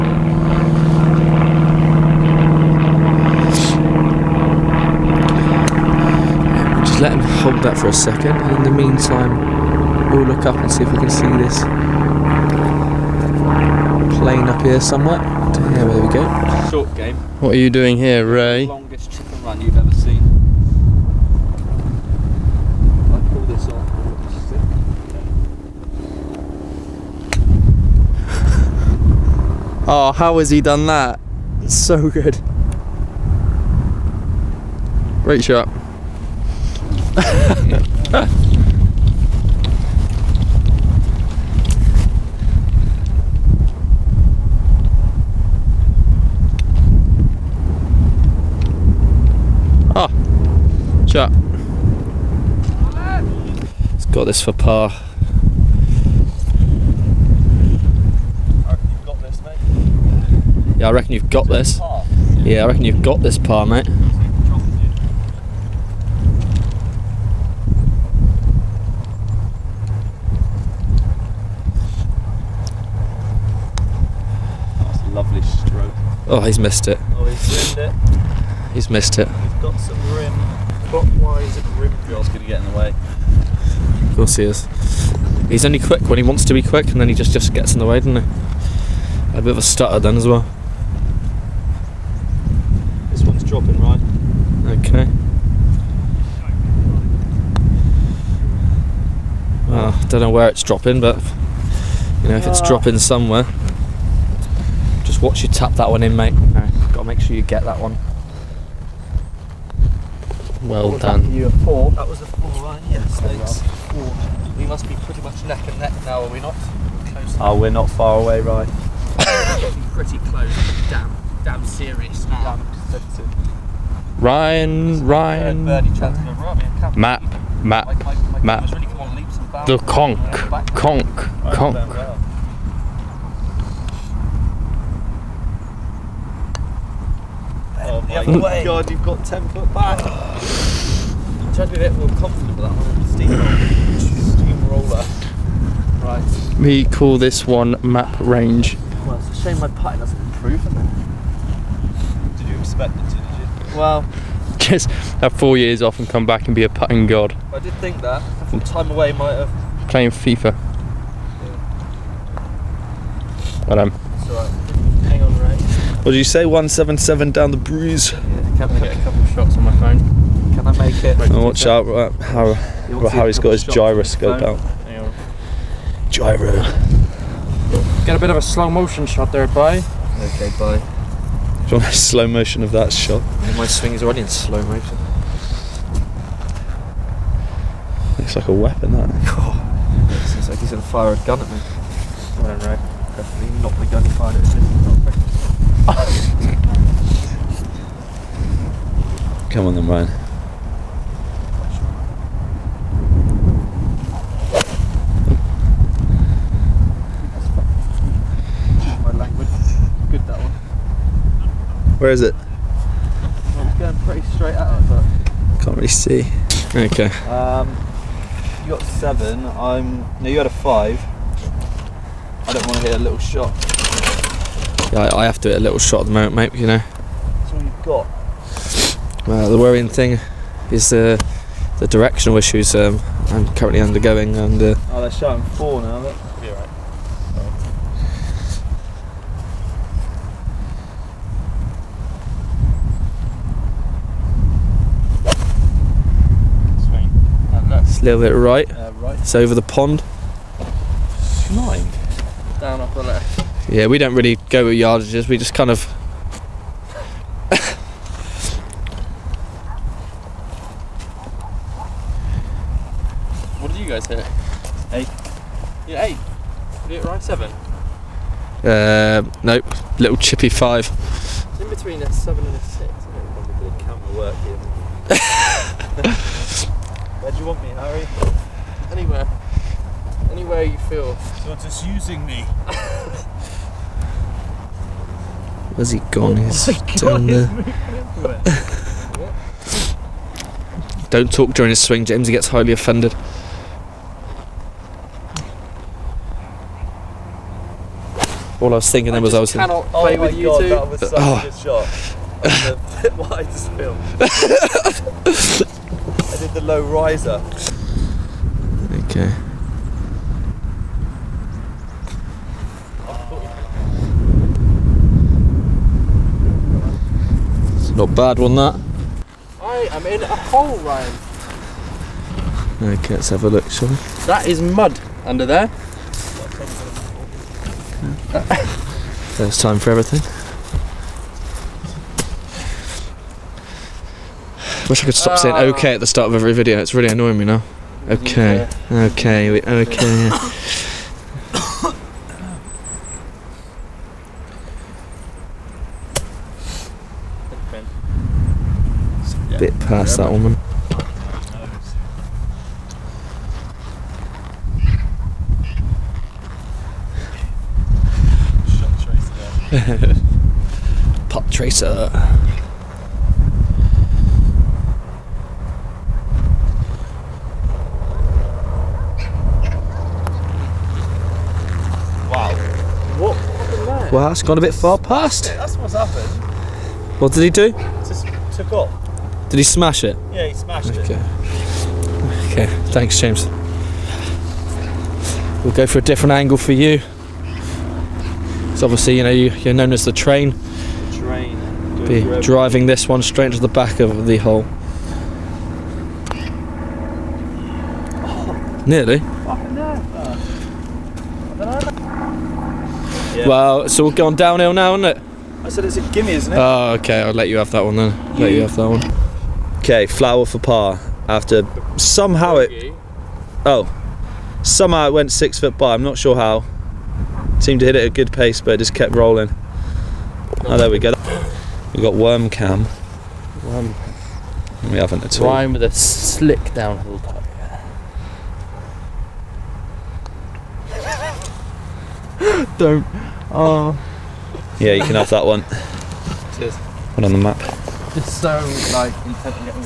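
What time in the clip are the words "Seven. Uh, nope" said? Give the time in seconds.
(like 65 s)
267 s.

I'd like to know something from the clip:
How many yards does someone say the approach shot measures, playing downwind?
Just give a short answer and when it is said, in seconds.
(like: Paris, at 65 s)
177, at 166 s.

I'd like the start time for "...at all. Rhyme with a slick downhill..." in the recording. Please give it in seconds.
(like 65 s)
425 s.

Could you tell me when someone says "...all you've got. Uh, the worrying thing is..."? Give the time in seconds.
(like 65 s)
227 s.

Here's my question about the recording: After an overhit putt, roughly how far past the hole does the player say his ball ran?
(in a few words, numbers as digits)
6 foot.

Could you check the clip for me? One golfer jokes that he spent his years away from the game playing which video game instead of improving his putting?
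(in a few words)
FIFA.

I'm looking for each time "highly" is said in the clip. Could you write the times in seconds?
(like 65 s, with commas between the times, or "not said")
292 s.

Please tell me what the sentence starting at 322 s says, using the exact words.
Okay, let's have a look, shall we?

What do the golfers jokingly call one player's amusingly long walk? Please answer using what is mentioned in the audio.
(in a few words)
Chicken run.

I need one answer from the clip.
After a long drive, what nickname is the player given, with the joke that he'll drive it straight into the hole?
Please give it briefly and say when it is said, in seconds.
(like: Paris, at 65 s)
The train, at 390 s.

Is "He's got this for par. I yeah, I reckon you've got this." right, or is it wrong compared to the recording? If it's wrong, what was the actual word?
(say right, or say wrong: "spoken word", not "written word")
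right.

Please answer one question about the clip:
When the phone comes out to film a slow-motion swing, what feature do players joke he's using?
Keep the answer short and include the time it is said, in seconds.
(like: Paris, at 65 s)
Gyroscope, at 173 s.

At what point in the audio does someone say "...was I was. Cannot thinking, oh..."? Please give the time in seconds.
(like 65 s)
299 s.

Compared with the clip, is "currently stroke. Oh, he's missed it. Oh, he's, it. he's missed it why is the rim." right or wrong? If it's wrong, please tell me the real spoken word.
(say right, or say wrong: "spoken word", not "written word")
wrong: "lovely", not "currently".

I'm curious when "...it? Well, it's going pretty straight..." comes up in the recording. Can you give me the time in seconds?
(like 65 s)
212 s.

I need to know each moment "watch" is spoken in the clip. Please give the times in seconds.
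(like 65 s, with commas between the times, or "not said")
105 s, 171 s.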